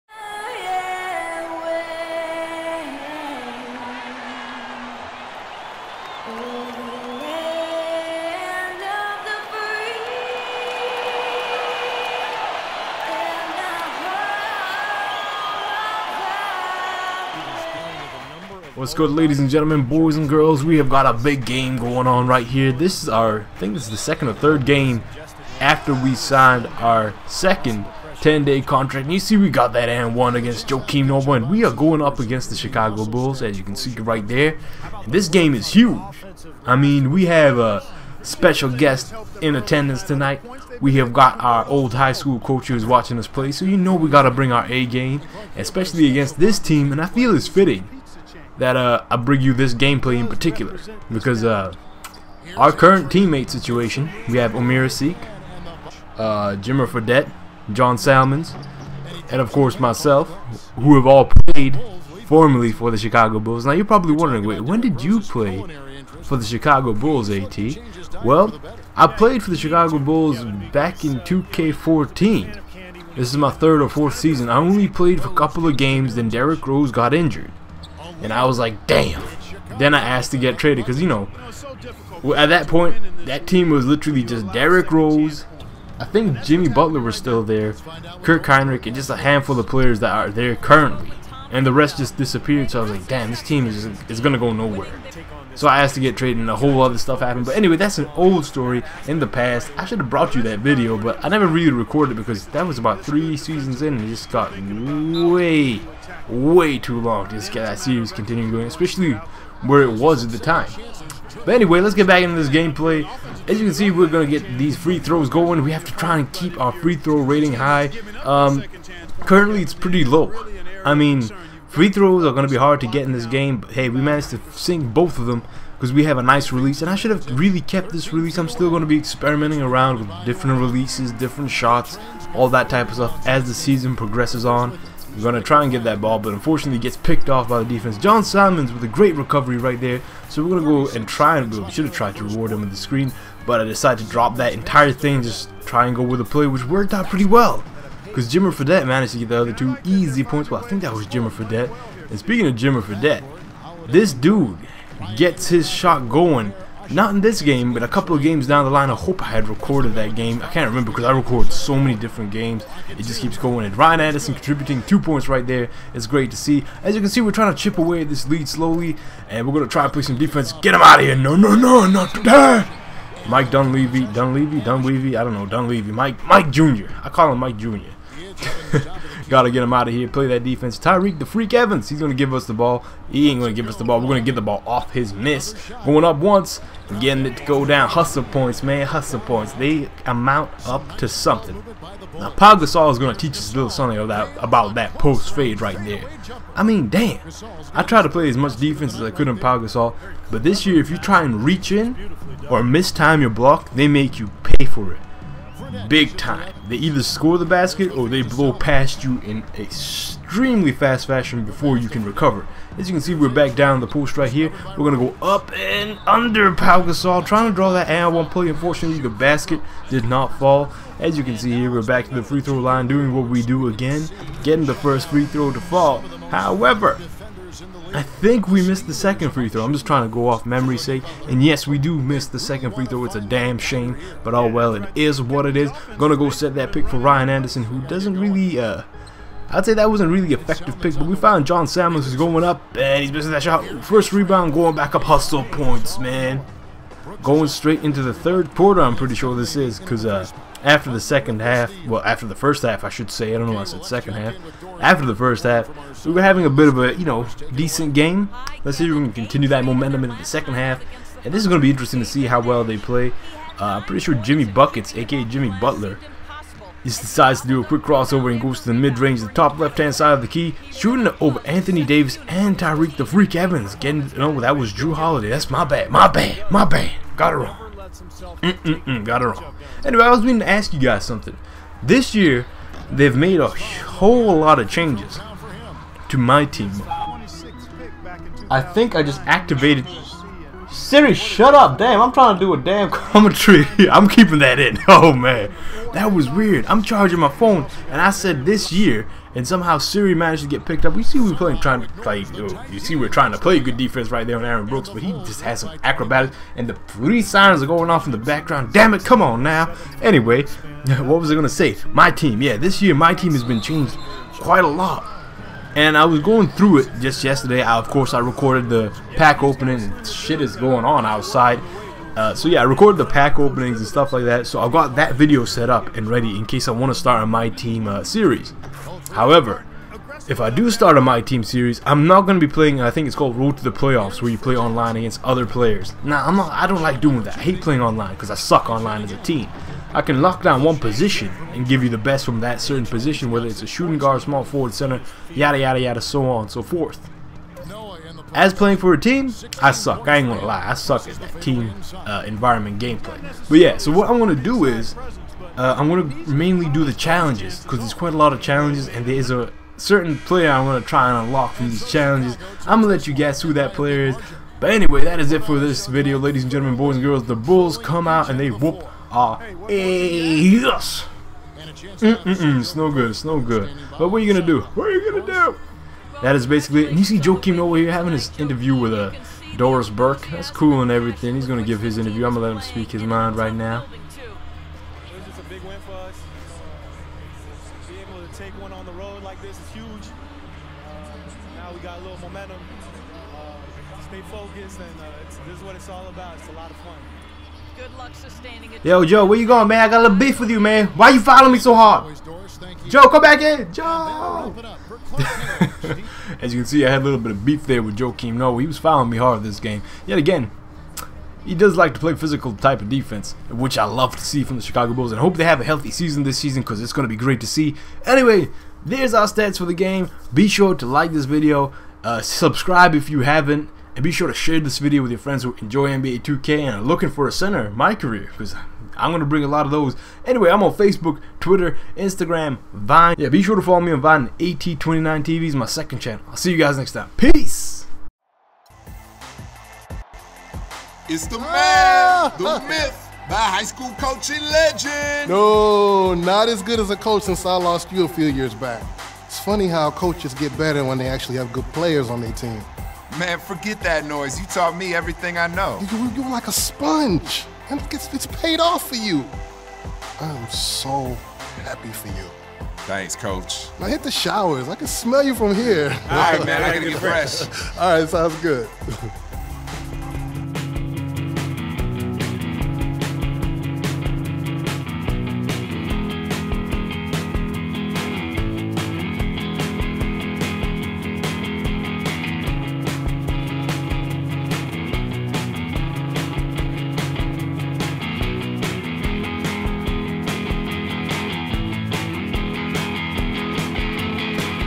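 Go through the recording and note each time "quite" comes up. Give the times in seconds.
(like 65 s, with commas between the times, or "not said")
314 s, 357 s.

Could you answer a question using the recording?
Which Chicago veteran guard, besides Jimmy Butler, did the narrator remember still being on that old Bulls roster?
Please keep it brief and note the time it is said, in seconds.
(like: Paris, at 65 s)
Kirk Hinrich, at 88 s.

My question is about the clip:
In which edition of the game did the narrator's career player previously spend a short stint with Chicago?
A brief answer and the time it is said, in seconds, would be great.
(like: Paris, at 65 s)
2K14, at 71 s.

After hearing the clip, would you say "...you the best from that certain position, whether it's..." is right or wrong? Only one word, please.
right.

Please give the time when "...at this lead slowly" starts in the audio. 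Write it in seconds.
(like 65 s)
168 s.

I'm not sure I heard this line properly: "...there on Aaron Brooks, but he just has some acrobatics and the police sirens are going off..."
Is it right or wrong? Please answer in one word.
right.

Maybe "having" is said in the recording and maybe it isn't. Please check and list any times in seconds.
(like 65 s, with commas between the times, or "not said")
256 s, 377 s.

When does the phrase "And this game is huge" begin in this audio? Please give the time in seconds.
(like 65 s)
35 s.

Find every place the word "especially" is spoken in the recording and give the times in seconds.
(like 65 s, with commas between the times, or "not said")
45 s, 108 s.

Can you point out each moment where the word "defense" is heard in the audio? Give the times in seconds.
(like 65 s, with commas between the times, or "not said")
137 s, 170 s, 180 s, 198 s, 303 s, 412 s.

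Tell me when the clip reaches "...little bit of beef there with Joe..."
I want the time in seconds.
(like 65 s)
407 s.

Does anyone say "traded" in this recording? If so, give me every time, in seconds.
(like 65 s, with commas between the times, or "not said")
80 s, 96 s.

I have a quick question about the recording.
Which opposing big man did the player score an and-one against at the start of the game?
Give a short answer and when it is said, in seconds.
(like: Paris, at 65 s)
Joakim Noah, at 30 s.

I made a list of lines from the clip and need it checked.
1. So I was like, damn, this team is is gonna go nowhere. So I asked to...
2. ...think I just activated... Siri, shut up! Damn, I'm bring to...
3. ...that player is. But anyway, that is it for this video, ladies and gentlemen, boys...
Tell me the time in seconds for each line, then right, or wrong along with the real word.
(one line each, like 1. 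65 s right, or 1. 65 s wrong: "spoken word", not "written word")
1. 92 s right
2. 288 s wrong: "trying", not "bring"
3. 363 s right.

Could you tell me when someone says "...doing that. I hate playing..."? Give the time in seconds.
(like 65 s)
337 s.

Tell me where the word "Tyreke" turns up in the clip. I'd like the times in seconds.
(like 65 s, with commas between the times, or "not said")
180 s, 272 s.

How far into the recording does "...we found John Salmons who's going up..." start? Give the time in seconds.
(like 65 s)
241 s.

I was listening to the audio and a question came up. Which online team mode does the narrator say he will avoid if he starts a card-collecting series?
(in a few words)
Road to the Playoffs.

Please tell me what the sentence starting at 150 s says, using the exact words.
Well, I think that was Jimmer Fredette.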